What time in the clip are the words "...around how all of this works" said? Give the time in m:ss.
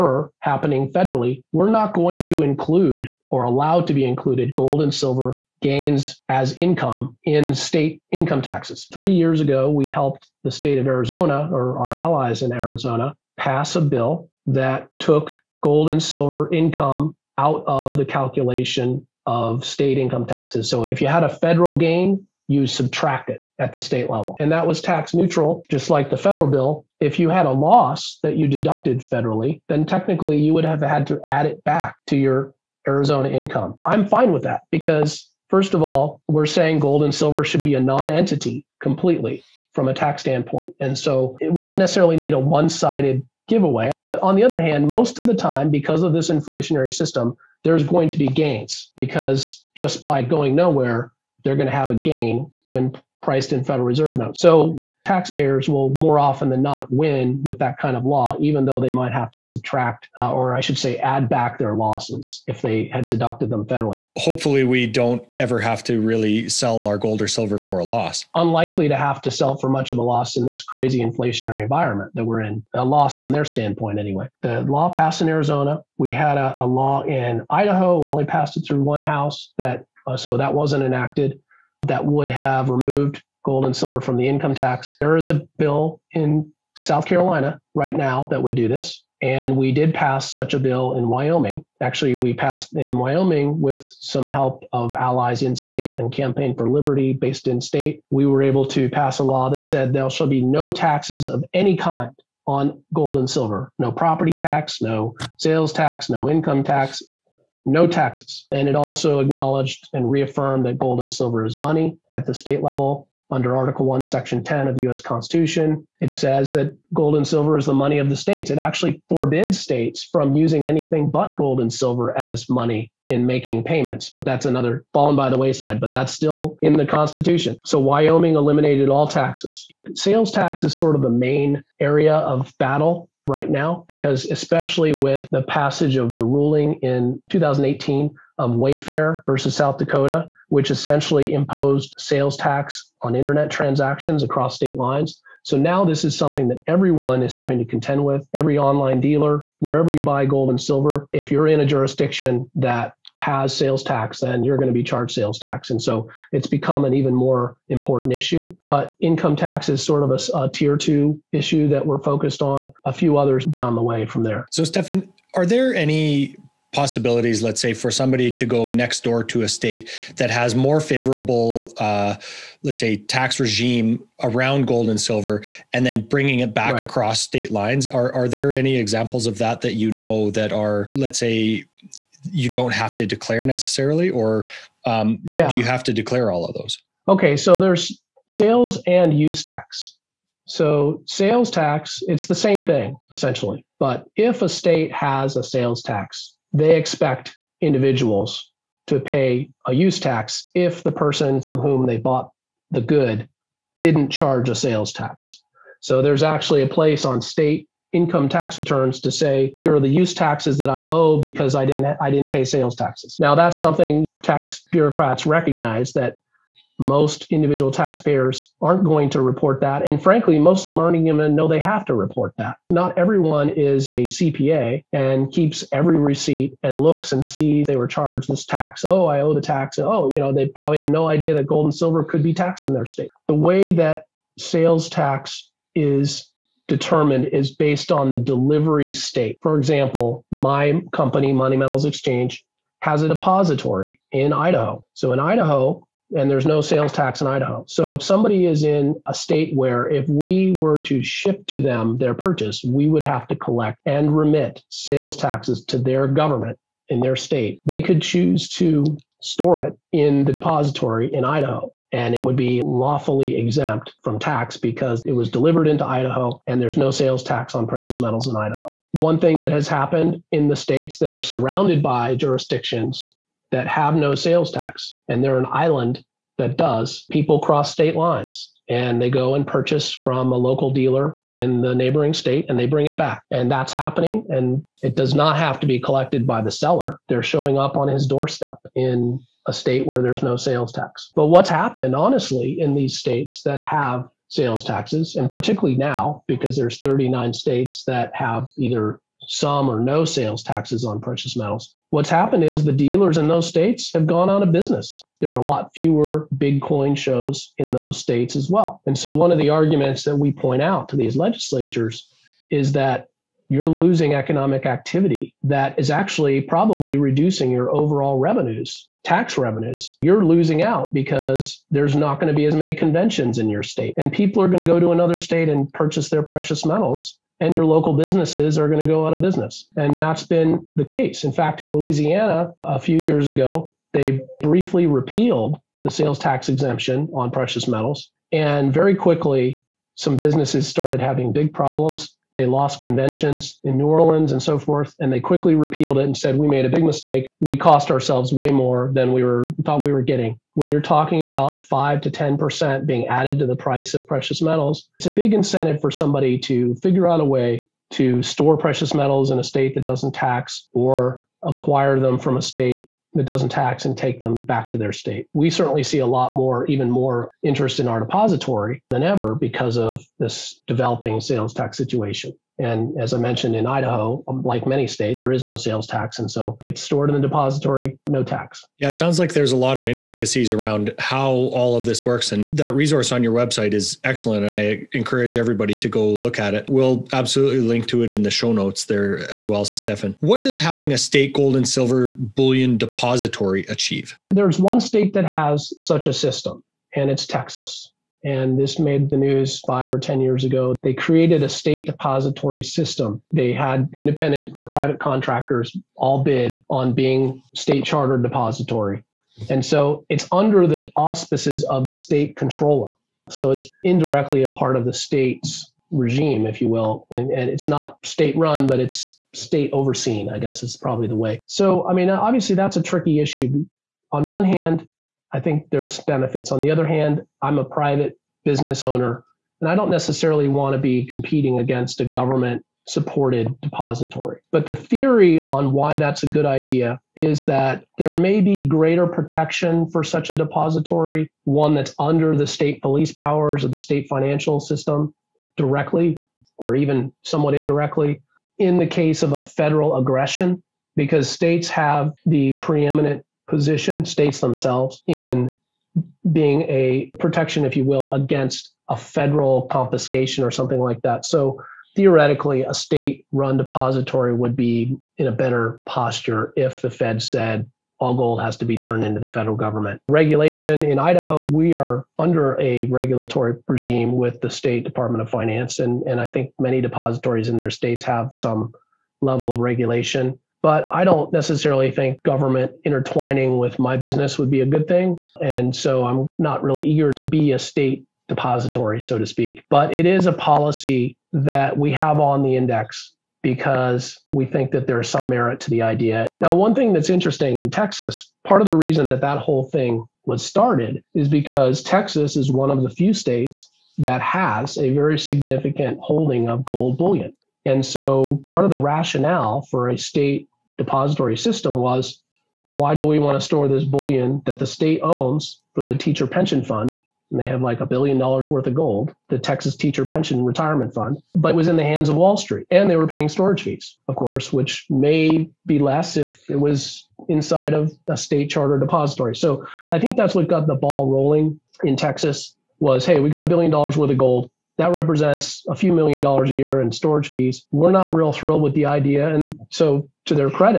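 6:20.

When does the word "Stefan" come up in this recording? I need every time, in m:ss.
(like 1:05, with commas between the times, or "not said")
2:44, 6:29.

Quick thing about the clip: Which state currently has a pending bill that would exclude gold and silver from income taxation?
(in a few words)
South Carolina.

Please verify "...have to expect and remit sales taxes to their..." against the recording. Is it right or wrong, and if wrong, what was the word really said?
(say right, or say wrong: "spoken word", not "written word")
wrong: "collect", not "expect".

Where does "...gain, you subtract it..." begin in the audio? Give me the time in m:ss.
0:21.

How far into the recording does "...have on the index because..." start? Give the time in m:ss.
8:11.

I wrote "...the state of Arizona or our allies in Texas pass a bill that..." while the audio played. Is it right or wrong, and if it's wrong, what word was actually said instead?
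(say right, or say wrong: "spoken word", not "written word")
wrong: "Arizona", not "Texas".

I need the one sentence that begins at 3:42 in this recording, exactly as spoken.
Not everyone is a CPA and keeps every receipt and looks and sees they were charged this tax.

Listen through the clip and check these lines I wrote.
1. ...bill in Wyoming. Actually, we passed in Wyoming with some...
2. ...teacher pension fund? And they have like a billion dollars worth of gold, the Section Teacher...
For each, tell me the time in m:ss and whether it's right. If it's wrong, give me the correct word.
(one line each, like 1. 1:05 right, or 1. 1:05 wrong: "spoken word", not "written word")
1. 1:30 right
2. 8:35 wrong: "Texas", not "Section".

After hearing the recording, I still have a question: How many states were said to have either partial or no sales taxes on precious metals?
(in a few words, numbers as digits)
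39.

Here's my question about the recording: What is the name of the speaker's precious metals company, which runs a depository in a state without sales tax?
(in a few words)
Money Metals Exchange.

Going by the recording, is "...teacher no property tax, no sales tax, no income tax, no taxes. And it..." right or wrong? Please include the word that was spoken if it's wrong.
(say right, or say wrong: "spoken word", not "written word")
wrong: "silver", not "teacher".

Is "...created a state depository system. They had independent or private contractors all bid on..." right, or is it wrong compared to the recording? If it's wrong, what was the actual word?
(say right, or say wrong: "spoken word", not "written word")
right.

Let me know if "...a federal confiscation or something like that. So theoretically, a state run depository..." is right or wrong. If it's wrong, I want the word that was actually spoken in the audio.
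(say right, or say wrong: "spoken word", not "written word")
right.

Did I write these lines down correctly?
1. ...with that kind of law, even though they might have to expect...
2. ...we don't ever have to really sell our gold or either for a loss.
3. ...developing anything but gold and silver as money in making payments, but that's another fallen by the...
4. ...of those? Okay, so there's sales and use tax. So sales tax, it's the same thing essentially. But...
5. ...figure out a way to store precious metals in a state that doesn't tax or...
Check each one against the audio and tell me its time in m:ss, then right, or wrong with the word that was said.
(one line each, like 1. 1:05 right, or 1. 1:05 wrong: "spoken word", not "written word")
1. 0:57 wrong: "subtract", not "expect"
2. 1:04 wrong: "silver", not "either"
3. 2:00 wrong: "using", not "developing"
4. 3:06 right
5. 5:56 right.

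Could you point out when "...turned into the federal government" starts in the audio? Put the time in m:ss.
7:48.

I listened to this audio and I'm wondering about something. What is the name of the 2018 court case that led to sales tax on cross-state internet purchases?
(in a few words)
Wayfair versus South Dakota.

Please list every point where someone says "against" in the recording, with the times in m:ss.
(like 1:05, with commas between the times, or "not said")
7:11, 7:38.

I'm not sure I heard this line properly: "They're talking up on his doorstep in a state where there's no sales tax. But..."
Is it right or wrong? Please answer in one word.
wrong.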